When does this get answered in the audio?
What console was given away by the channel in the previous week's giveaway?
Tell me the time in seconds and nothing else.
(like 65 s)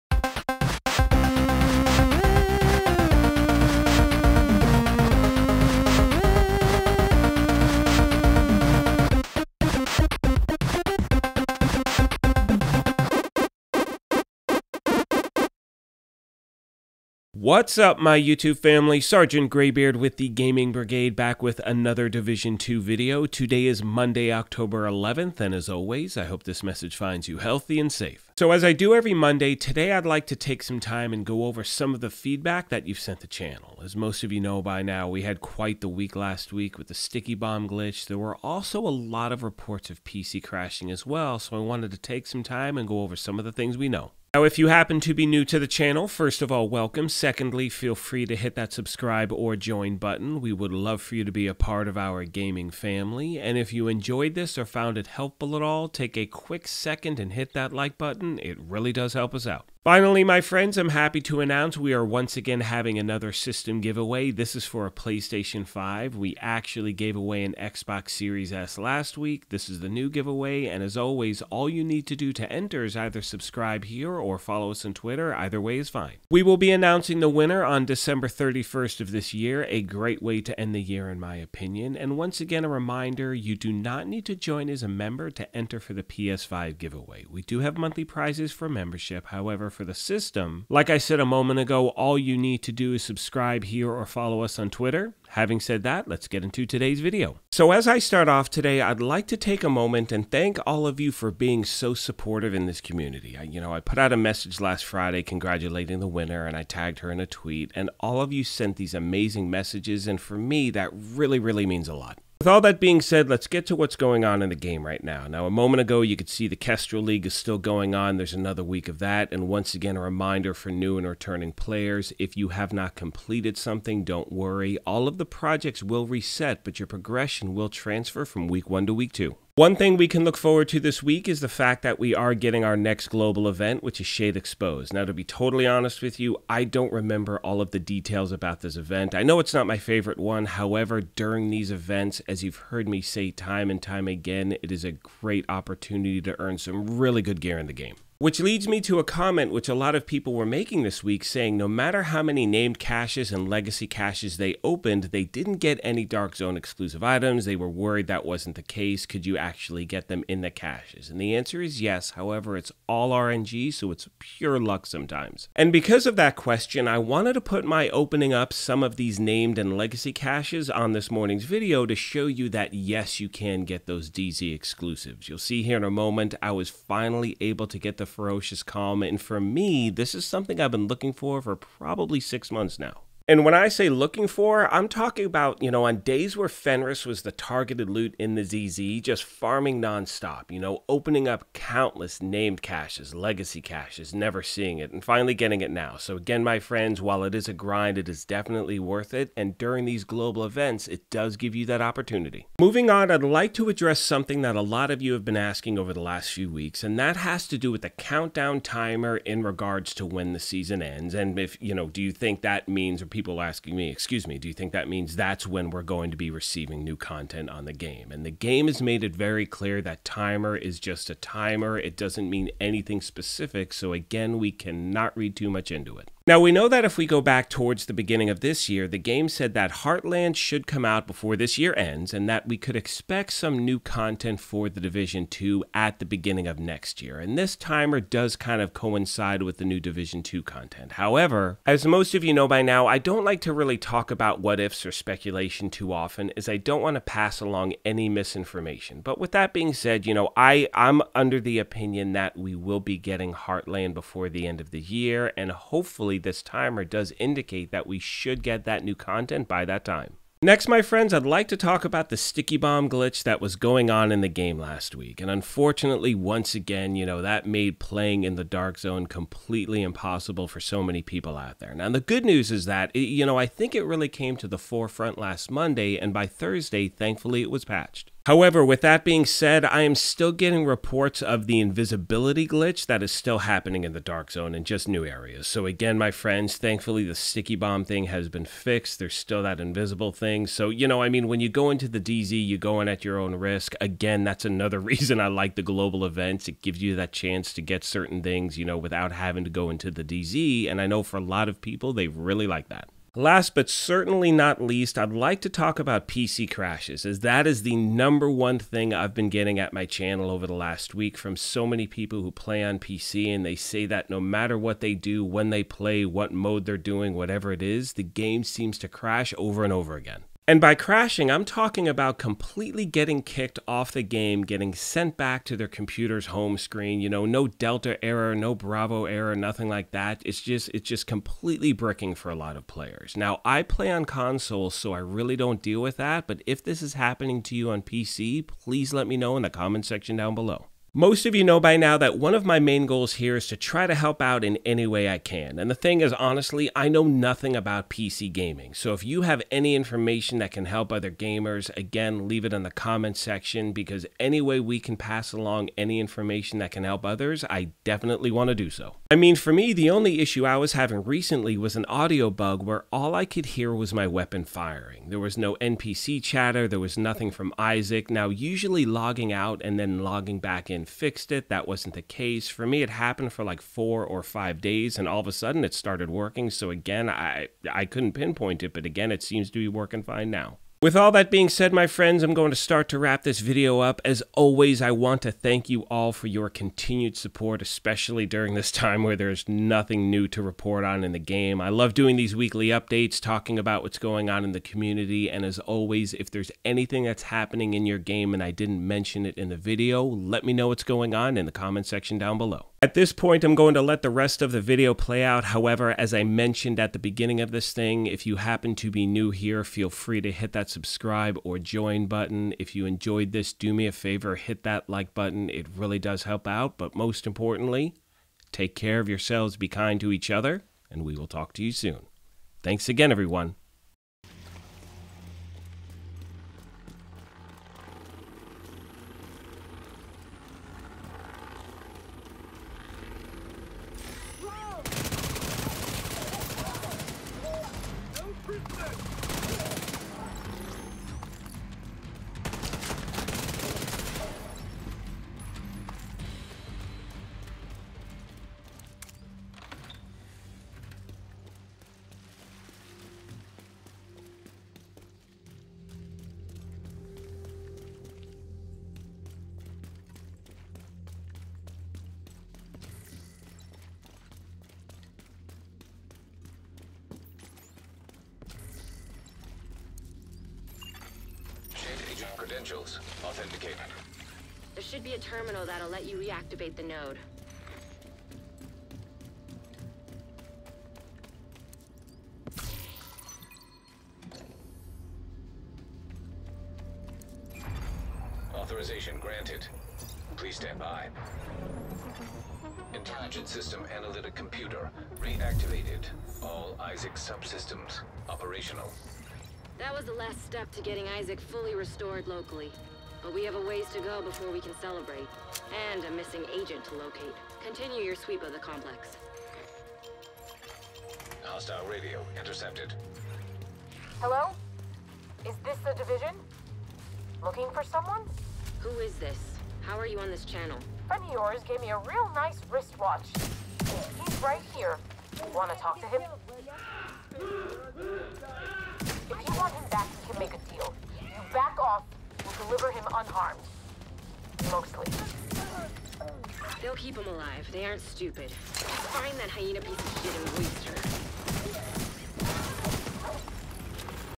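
67 s.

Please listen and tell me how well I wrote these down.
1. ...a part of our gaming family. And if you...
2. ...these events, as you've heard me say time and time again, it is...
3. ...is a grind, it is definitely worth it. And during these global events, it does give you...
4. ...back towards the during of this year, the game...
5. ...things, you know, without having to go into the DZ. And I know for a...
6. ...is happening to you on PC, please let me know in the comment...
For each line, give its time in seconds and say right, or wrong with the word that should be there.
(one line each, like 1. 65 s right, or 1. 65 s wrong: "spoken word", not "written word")
1. 51 s right
2. 141 s right
3. 197 s right
4. 227 s wrong: "beginning", not "during"
5. 298 s right
6. 336 s right.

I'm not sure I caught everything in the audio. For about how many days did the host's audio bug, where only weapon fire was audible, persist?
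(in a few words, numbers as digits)
4 or 5 days.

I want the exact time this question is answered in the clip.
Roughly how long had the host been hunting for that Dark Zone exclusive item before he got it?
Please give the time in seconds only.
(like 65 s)
182 s.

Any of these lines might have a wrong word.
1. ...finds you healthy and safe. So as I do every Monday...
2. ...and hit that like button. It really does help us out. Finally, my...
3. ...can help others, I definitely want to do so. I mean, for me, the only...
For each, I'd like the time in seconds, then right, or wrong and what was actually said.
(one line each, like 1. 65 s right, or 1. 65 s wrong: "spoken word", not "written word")
1. 26 s right
2. 57 s right
3. 356 s right.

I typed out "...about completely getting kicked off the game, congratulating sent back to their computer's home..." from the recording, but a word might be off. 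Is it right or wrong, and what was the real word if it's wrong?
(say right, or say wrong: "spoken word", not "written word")
wrong: "getting", not "congratulating".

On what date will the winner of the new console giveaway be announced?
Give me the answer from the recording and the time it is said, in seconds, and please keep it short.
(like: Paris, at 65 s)
December 31st, at 77 s.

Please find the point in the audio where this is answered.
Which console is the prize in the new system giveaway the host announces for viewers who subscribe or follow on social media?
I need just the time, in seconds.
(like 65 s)
64 s.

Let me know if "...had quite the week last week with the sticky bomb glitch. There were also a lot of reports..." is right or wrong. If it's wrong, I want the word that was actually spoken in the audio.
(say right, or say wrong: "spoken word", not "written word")
right.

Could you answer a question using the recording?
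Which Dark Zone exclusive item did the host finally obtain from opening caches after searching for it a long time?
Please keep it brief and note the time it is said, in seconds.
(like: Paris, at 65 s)
Ferocious Calm, at 178 s.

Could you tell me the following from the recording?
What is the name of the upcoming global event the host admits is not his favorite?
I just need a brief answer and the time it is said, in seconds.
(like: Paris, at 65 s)
Shade Exposed, at 134 s.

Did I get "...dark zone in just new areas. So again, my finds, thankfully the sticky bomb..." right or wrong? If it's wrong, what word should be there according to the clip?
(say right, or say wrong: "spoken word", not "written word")
wrong: "friends", not "finds".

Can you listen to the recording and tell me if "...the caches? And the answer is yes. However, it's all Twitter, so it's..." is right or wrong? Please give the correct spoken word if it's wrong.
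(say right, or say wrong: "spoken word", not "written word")
wrong: "RNG", not "Twitter".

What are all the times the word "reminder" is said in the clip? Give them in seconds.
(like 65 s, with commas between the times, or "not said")
82 s, 120 s.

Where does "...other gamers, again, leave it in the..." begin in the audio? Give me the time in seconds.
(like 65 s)
350 s.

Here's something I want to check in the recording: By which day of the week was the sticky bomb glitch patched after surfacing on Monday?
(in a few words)
Thursday.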